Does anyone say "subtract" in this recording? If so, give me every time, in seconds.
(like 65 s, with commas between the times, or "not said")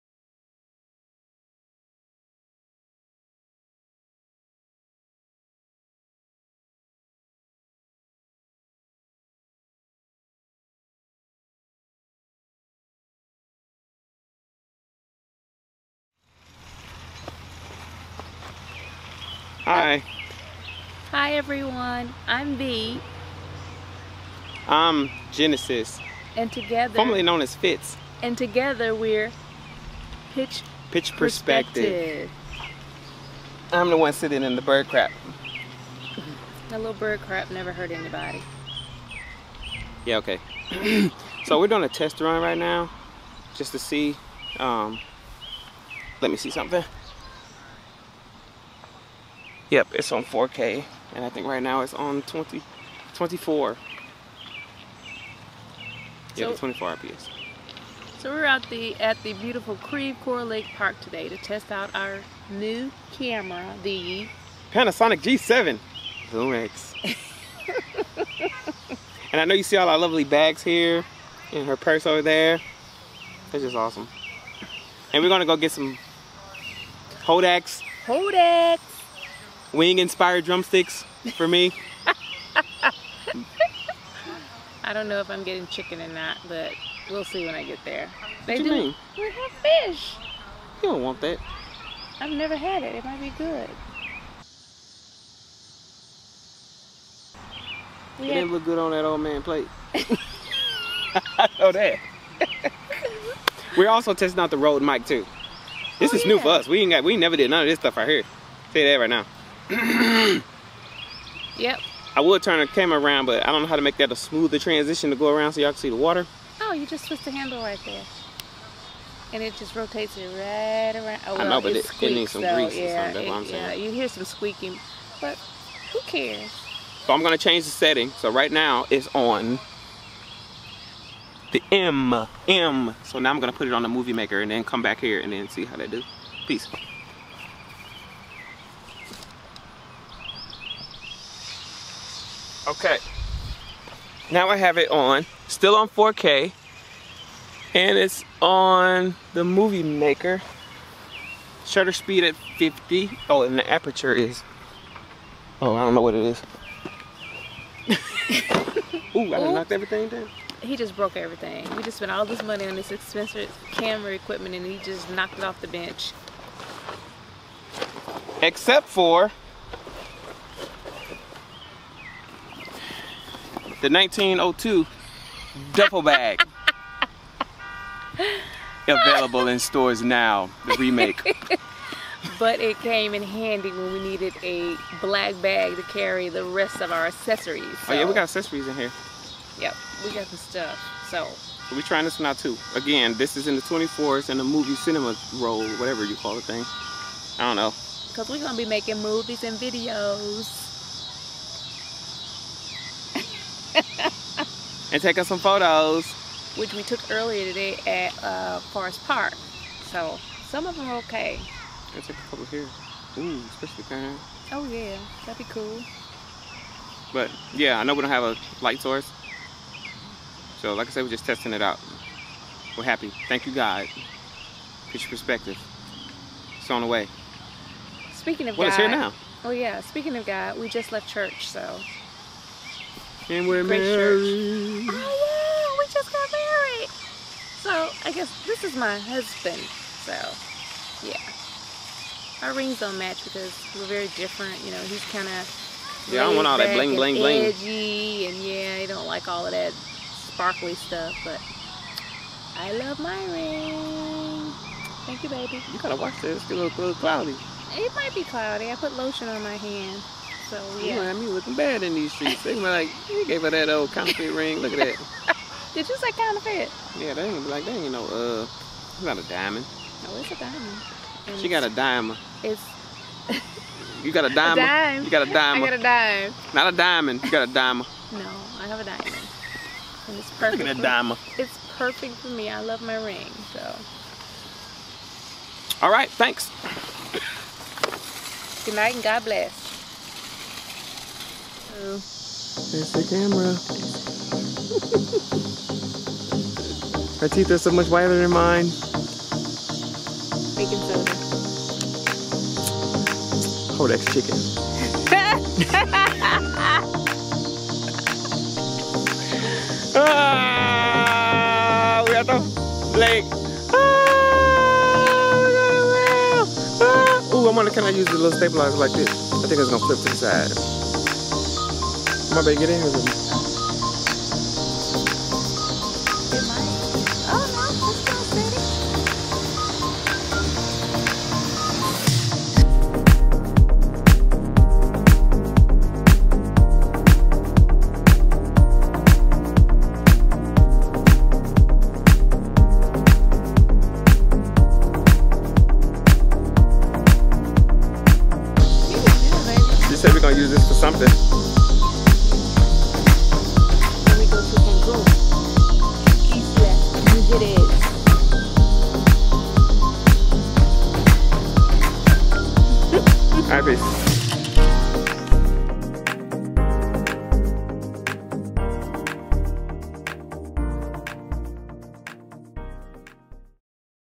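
not said.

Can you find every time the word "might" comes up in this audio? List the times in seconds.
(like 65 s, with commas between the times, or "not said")
93 s, 257 s.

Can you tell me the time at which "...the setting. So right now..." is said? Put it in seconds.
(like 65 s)
127 s.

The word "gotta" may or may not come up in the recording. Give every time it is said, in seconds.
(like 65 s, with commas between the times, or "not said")
211 s, 255 s.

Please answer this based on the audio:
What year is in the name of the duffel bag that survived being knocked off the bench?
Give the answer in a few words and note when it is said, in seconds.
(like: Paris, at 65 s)
1902, at 173 s.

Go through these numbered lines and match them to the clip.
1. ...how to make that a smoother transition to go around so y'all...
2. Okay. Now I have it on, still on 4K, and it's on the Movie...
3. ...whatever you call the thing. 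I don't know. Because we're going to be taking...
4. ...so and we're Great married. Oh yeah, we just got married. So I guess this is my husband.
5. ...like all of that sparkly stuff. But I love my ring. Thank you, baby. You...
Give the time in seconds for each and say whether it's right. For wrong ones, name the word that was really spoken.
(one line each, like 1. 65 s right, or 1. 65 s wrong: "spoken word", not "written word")
1. 113 s right
2. 142 s right
3. 195 s wrong: "making", not "taking"
4. 231 s right
5. 249 s right.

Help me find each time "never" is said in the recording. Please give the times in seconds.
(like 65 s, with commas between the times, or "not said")
37 s, 92 s, 107 s.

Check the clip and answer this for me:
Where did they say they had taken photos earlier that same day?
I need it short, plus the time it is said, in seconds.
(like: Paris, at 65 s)
Forest Park, at 208 s.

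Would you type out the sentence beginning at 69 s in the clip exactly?
and I know you see all our lovely bags here, and her purse over there.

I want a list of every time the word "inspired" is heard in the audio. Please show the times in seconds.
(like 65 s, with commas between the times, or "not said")
79 s.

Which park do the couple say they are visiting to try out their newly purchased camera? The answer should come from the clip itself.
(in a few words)
Creve Coeur Lake Park.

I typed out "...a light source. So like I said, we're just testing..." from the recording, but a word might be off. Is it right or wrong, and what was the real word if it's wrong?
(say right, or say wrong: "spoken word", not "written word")
right.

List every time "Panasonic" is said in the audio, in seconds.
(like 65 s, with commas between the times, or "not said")
64 s.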